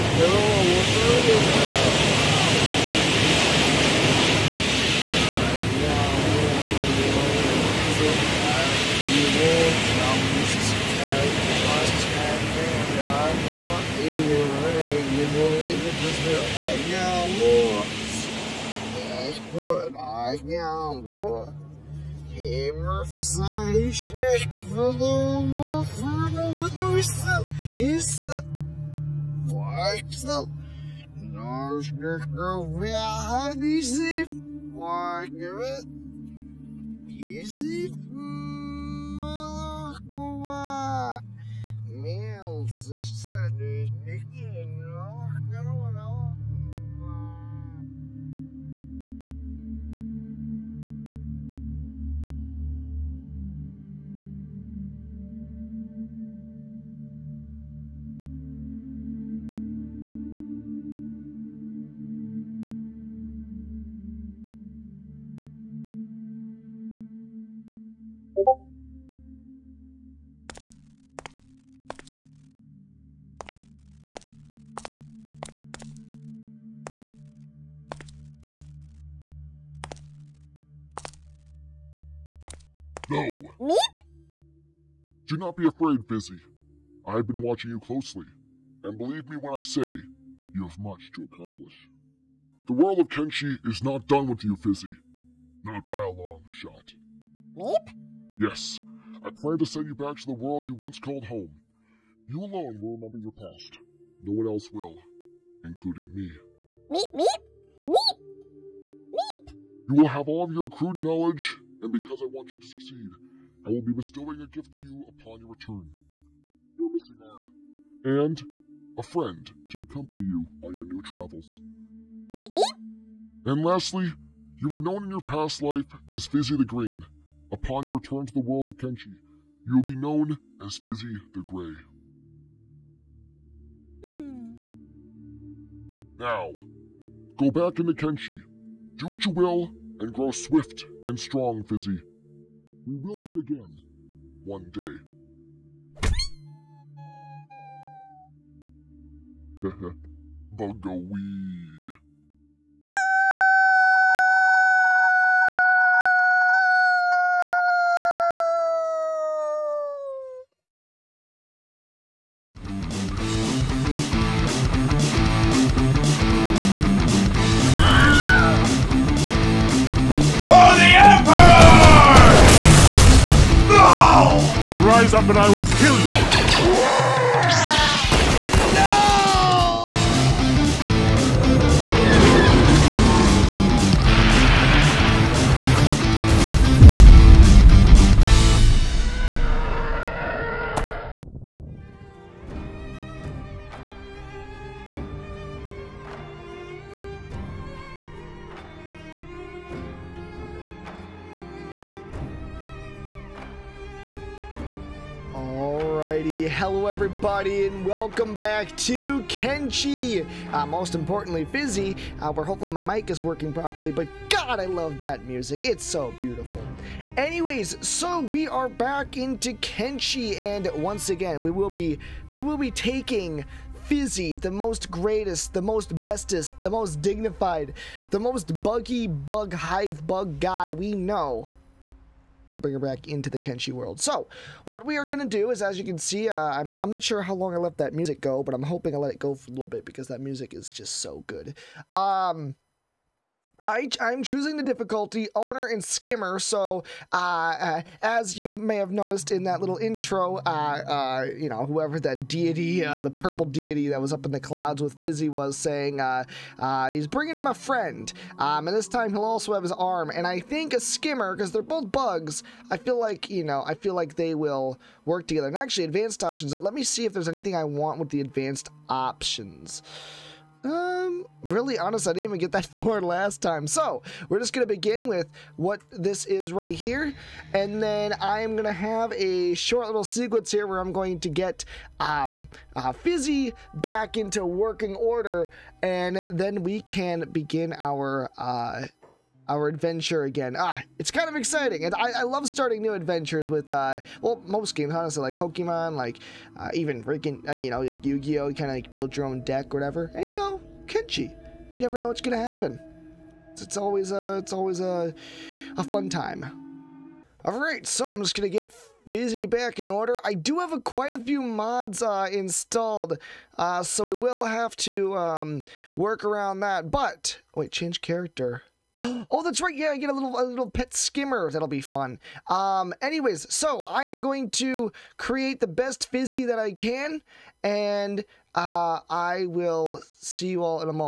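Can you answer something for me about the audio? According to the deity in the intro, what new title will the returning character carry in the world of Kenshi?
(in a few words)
Fizzy the Grey.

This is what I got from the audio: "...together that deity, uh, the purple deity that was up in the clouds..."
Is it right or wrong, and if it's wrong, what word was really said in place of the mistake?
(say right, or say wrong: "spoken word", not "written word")
wrong: "whoever", not "together".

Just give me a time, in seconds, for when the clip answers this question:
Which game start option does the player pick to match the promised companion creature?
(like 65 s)
245 s.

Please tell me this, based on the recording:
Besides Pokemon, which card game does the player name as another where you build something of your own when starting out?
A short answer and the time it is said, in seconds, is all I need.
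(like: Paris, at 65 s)
Yu-Gi-Oh, at 298 s.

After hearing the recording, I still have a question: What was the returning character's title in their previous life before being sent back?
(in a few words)
Fizzy the Green.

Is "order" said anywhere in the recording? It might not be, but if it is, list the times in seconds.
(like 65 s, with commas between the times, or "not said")
284 s, 309 s.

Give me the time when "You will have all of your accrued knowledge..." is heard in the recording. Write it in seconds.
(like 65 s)
109 s.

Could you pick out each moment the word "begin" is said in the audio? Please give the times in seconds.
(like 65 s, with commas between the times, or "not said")
274 s, 287 s.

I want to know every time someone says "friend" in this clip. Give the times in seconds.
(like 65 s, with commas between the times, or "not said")
119 s, 257 s.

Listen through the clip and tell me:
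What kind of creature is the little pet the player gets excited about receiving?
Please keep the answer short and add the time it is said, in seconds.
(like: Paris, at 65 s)
A skimmer, at 320 s.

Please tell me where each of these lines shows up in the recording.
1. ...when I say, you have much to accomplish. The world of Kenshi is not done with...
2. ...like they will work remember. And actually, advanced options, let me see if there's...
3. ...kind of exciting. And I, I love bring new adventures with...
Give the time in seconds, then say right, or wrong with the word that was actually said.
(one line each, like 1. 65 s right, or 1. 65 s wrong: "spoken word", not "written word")
1. 89 s right
2. 263 s wrong: "together", not "remember"
3. 291 s wrong: "starting", not "bring".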